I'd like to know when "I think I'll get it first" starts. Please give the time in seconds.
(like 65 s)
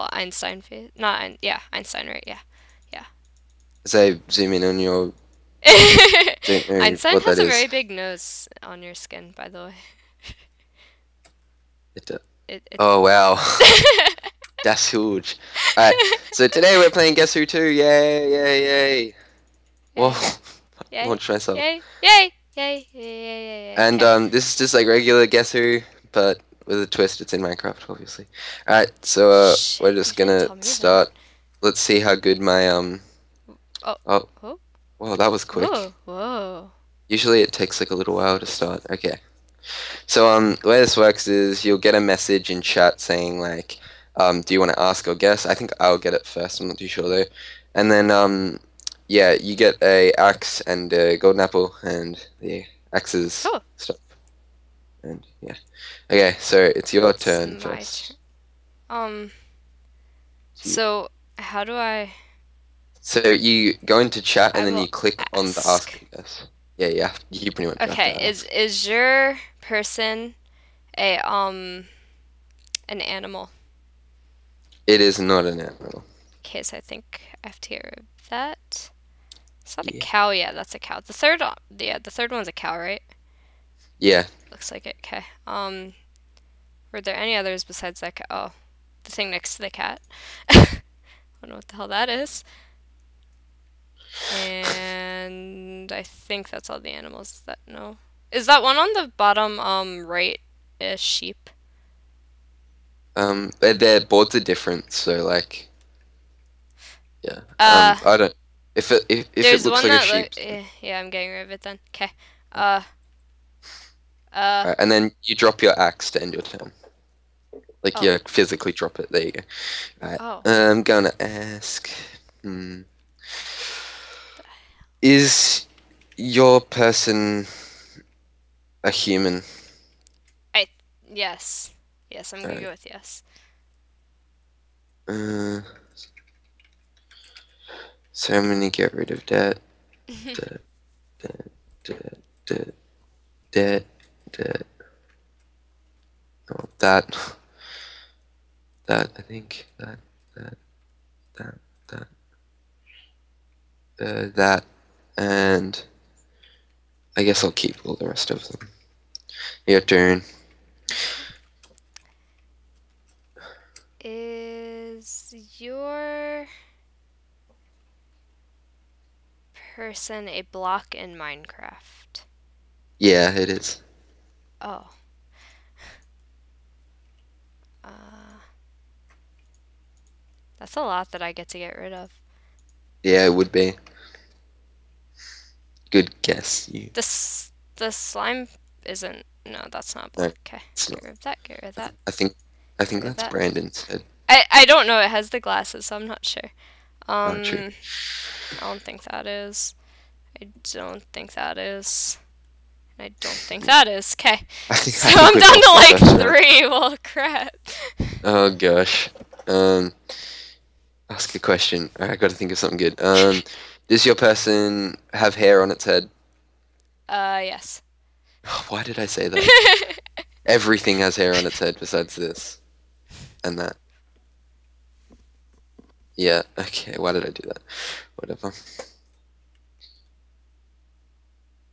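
45 s.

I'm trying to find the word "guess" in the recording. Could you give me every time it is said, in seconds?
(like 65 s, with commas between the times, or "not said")
17 s, 25 s, 45 s, 157 s, 186 s.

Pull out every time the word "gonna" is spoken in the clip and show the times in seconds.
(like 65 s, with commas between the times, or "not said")
30 s, 120 s, 132 s, 138 s.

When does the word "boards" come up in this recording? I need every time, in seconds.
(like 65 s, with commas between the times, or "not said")
104 s.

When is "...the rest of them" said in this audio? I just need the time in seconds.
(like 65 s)
157 s.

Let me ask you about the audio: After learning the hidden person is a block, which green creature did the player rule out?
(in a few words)
slime.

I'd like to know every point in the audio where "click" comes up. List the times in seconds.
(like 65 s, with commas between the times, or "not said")
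64 s.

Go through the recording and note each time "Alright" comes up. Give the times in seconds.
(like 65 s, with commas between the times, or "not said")
15 s, 28 s.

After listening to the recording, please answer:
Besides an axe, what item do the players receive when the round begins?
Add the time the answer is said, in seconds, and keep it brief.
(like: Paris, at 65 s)
golden apple, at 51 s.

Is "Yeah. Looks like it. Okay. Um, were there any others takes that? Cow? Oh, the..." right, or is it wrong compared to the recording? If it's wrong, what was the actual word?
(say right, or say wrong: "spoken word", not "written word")
wrong: "besides", not "takes".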